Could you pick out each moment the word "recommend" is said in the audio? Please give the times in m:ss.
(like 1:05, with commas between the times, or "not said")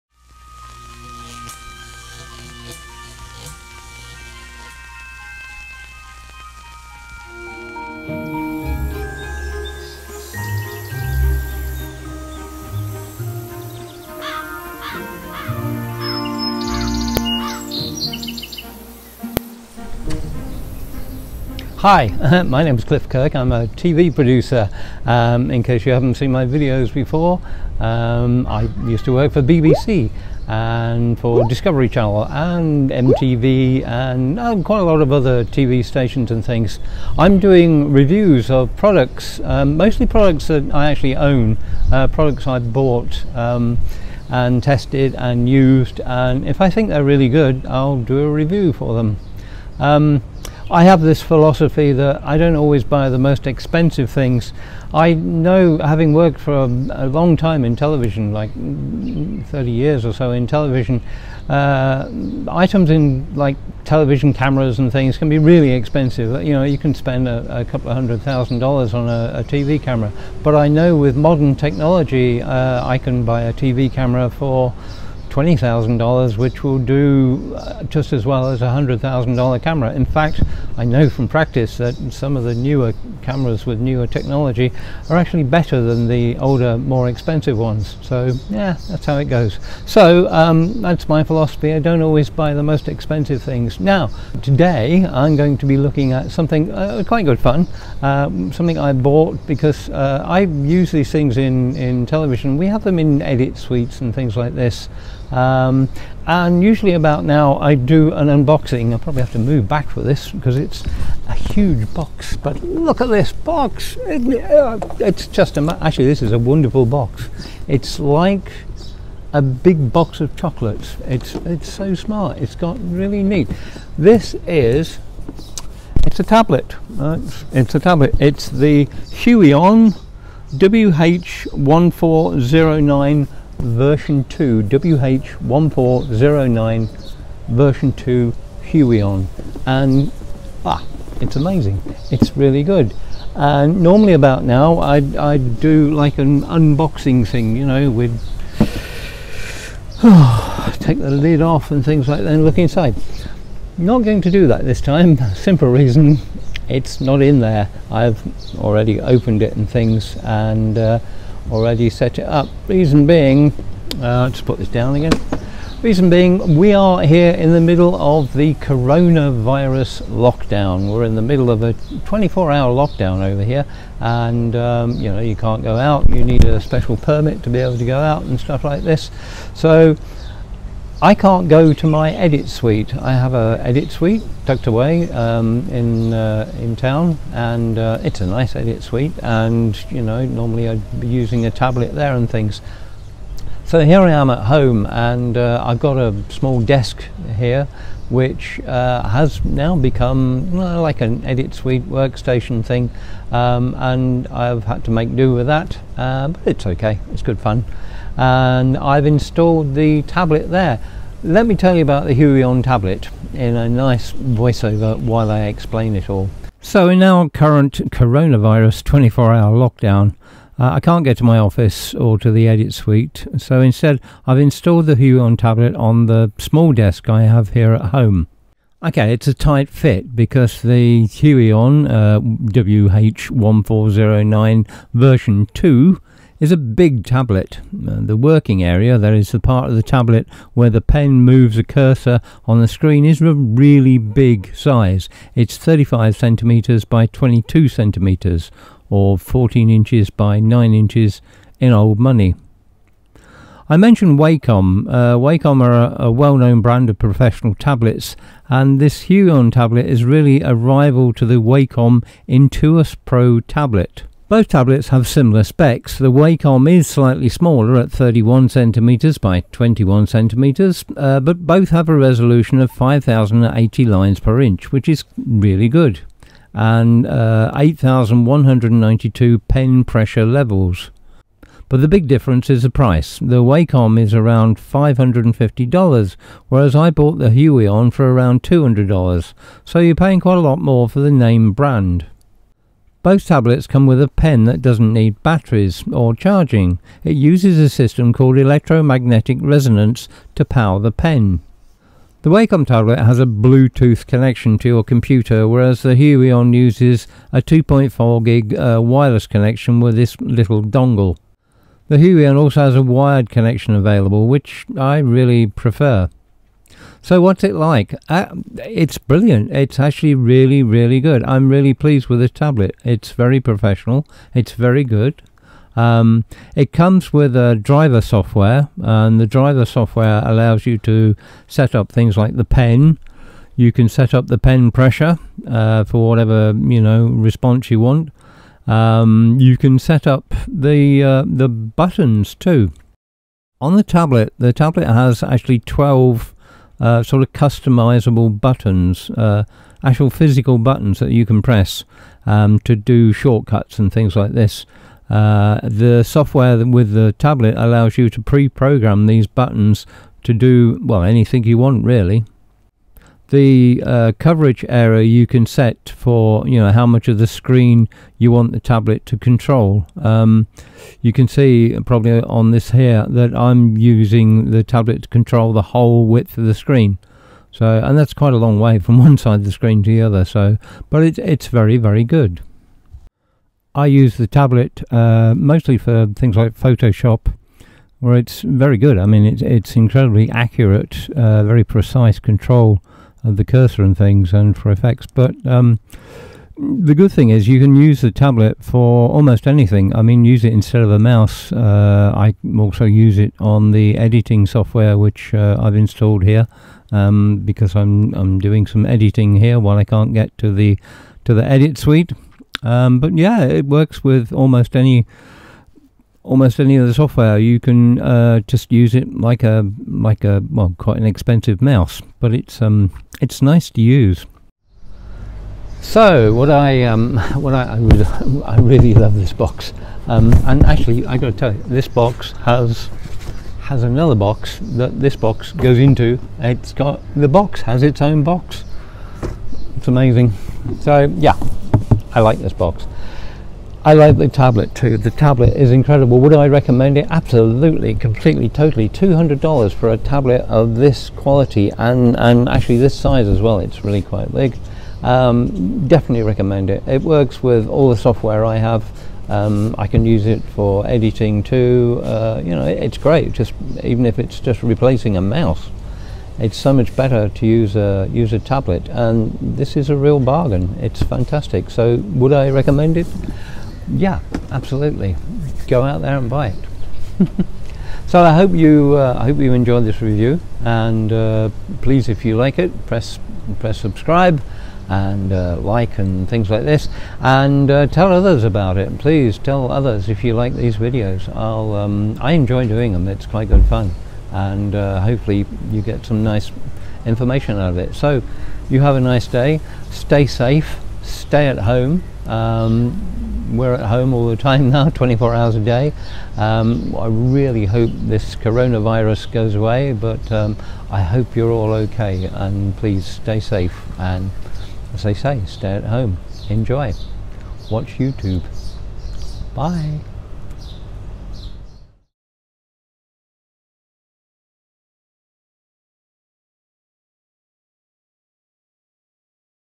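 7:26, 7:36, 7:52.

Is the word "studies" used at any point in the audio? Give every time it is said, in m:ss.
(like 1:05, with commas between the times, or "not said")
not said.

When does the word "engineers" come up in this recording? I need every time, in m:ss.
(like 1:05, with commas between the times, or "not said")
not said.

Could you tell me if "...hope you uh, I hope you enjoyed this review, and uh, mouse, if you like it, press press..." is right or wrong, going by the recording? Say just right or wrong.
wrong.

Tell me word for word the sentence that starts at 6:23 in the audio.
I use the tablet uh, mostly for things like Photoshop where it's very good.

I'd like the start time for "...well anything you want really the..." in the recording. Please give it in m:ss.
6:00.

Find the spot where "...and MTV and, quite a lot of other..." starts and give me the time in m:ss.
0:32.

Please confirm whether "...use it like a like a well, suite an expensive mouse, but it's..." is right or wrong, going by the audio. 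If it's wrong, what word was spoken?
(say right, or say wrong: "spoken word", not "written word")
wrong: "quite", not "suite".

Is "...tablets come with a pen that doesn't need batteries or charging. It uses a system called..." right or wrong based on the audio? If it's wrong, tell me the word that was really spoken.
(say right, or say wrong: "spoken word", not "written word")
right.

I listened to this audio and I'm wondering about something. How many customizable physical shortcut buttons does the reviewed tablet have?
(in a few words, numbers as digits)
12.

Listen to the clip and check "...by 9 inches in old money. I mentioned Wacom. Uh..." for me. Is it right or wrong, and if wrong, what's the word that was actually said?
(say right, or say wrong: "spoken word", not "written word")
right.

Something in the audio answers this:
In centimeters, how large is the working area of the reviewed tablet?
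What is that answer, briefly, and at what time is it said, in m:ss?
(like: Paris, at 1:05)
35 cm by 22 cm, at 4:05.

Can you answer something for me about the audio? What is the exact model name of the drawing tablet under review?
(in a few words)
Huion WH1409 version 2.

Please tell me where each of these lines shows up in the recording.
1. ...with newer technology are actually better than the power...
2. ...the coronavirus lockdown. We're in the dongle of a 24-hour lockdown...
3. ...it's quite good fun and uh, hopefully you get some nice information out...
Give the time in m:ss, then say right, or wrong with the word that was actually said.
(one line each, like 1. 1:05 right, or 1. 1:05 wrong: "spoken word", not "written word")
1. 1:23 wrong: "older", not "power"
2. 2:48 wrong: "middle", not "dongle"
3. 8:13 right.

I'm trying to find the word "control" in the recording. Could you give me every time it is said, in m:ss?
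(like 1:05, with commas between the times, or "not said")
6:09, 6:15, 6:32.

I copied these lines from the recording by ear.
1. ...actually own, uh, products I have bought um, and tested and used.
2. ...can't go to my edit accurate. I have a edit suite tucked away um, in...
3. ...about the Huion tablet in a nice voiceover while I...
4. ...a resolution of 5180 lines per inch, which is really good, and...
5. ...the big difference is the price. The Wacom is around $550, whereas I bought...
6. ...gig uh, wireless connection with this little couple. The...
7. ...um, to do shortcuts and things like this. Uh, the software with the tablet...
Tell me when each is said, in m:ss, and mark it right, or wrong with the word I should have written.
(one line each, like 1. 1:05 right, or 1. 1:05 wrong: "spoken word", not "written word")
1. 0:40 right
2. 3:01 wrong: "suite", not "accurate"
3. 3:31 right
4. 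4:31 wrong: "5080", not "5180"
5. 4:41 right
6. 5:08 wrong: "dongle", not "couple"
7. 5:52 right.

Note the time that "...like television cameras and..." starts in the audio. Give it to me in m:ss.
1:03.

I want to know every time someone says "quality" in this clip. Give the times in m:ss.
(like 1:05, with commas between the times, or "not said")
7:31.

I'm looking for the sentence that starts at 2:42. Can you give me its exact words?
Reason being, uh, just put this down again.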